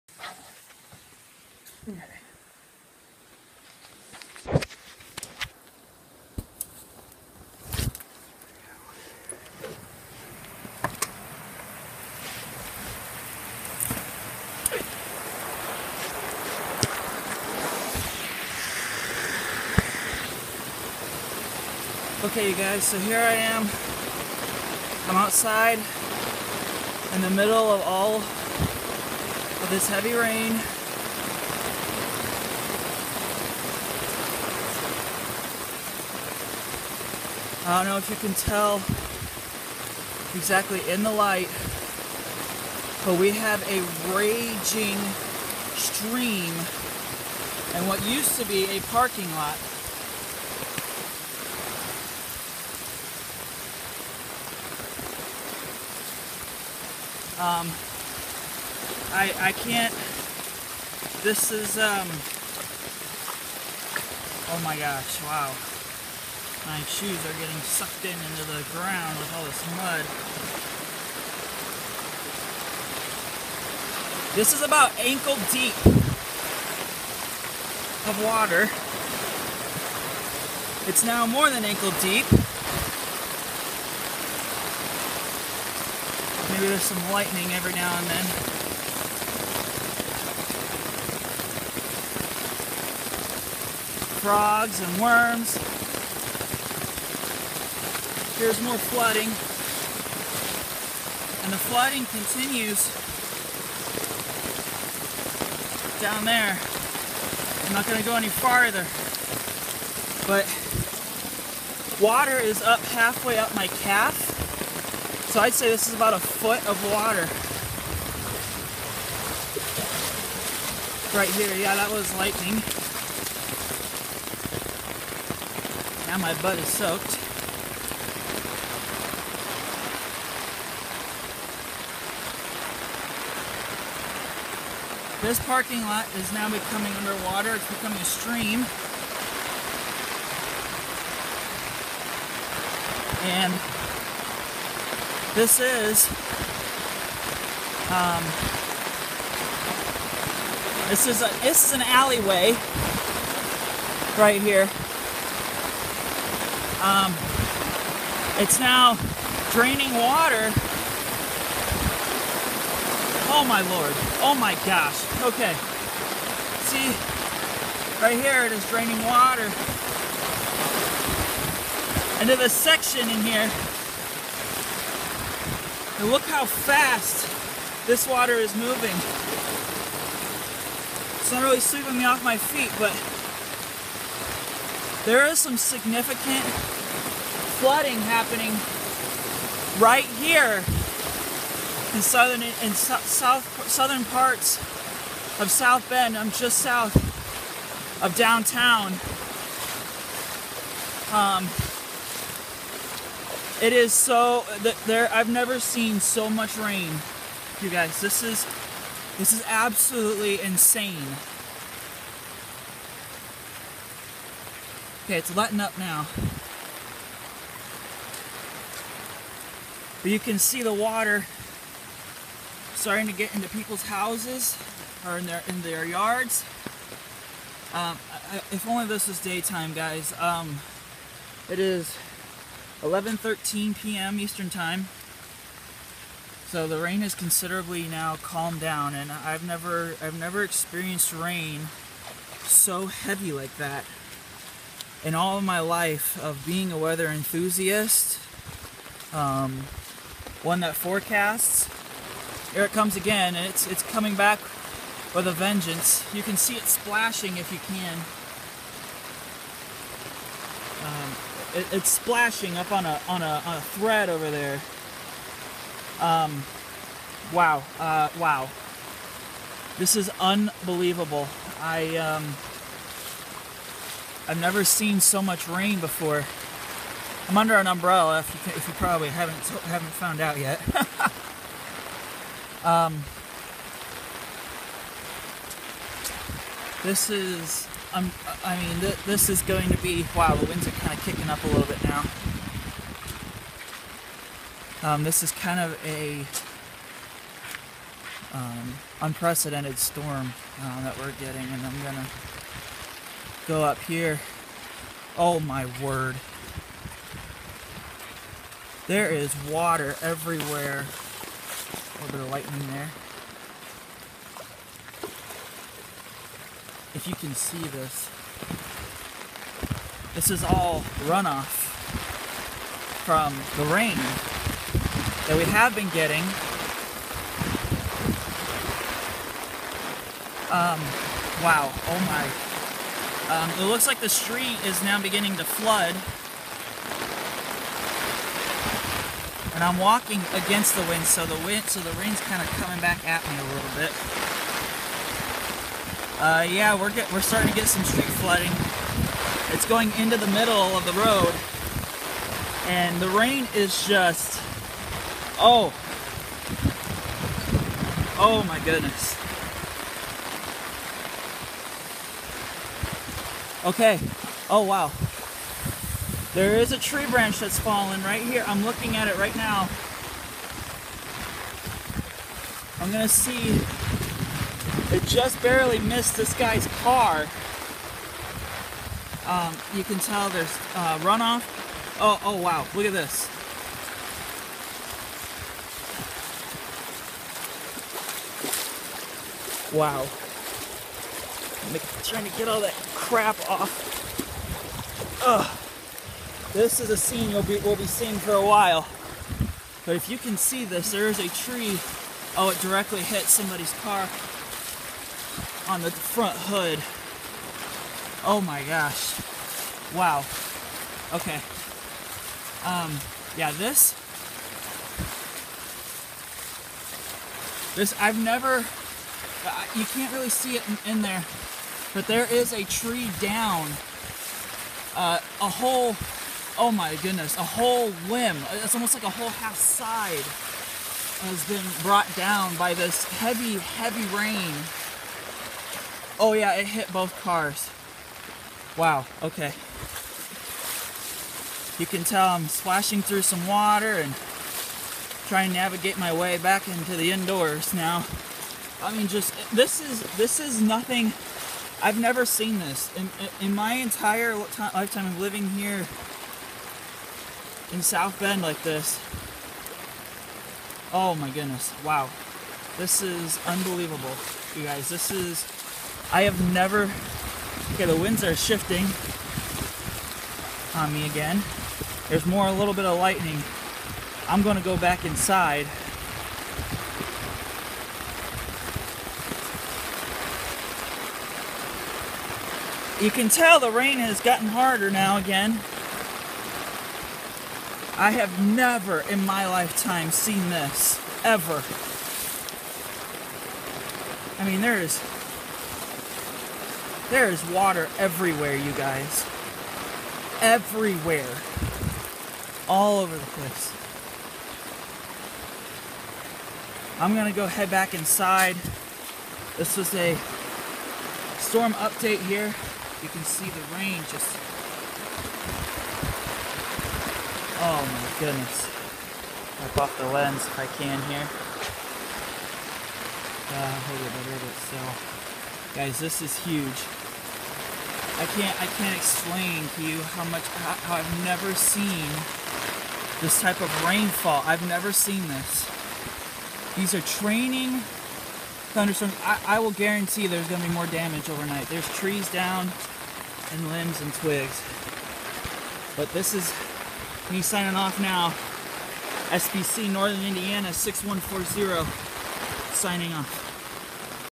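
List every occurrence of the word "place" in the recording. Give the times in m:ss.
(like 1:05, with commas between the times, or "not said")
8:23.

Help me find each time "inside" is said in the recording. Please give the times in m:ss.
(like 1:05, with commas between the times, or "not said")
7:55, 8:27.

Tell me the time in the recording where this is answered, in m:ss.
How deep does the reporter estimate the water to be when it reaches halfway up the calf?
1:55.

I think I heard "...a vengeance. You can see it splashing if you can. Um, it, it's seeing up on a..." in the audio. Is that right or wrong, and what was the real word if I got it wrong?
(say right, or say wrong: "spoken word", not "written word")
wrong: "splashing", not "seeing".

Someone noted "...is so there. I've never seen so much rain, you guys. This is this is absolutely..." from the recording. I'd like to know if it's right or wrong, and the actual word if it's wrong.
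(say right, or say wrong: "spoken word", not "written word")
right.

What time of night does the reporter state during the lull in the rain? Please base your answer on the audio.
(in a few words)
11:13 p.m.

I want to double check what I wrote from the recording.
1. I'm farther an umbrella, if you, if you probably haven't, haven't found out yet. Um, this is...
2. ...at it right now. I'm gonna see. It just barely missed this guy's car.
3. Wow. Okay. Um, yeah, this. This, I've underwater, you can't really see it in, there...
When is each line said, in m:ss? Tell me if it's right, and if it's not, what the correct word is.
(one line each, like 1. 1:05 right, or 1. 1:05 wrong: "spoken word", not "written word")
1. 4:37 wrong: "under", not "farther"
2. 6:08 right
3. 6:49 wrong: "never", not "underwater".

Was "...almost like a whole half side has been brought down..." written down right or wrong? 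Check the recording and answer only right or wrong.
right.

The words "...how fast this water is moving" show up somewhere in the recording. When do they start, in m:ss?
2:56.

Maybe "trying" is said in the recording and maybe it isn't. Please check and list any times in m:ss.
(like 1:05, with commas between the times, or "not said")
6:32, 7:25.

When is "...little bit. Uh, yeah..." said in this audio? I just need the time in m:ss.
5:43.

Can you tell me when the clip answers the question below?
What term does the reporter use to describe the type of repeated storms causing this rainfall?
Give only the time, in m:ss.
8:57.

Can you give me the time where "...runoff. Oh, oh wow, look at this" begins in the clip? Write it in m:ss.
6:21.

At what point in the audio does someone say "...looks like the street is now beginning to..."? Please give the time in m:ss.
5:33.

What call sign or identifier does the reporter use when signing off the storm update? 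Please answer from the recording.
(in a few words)
SBC Northern Indiana 6140.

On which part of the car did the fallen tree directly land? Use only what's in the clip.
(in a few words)
Front hood.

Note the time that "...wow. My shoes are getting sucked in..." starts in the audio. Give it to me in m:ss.
1:05.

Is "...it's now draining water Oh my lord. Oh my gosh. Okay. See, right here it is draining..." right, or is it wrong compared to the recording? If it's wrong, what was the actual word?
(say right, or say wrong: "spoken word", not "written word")
right.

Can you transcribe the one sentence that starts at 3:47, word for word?
Um, I, if only this was daytime, guys.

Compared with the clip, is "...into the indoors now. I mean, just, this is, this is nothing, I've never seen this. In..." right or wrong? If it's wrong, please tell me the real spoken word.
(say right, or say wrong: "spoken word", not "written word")
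right.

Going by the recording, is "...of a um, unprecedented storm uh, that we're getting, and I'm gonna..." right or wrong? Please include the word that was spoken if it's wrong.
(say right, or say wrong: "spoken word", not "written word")
right.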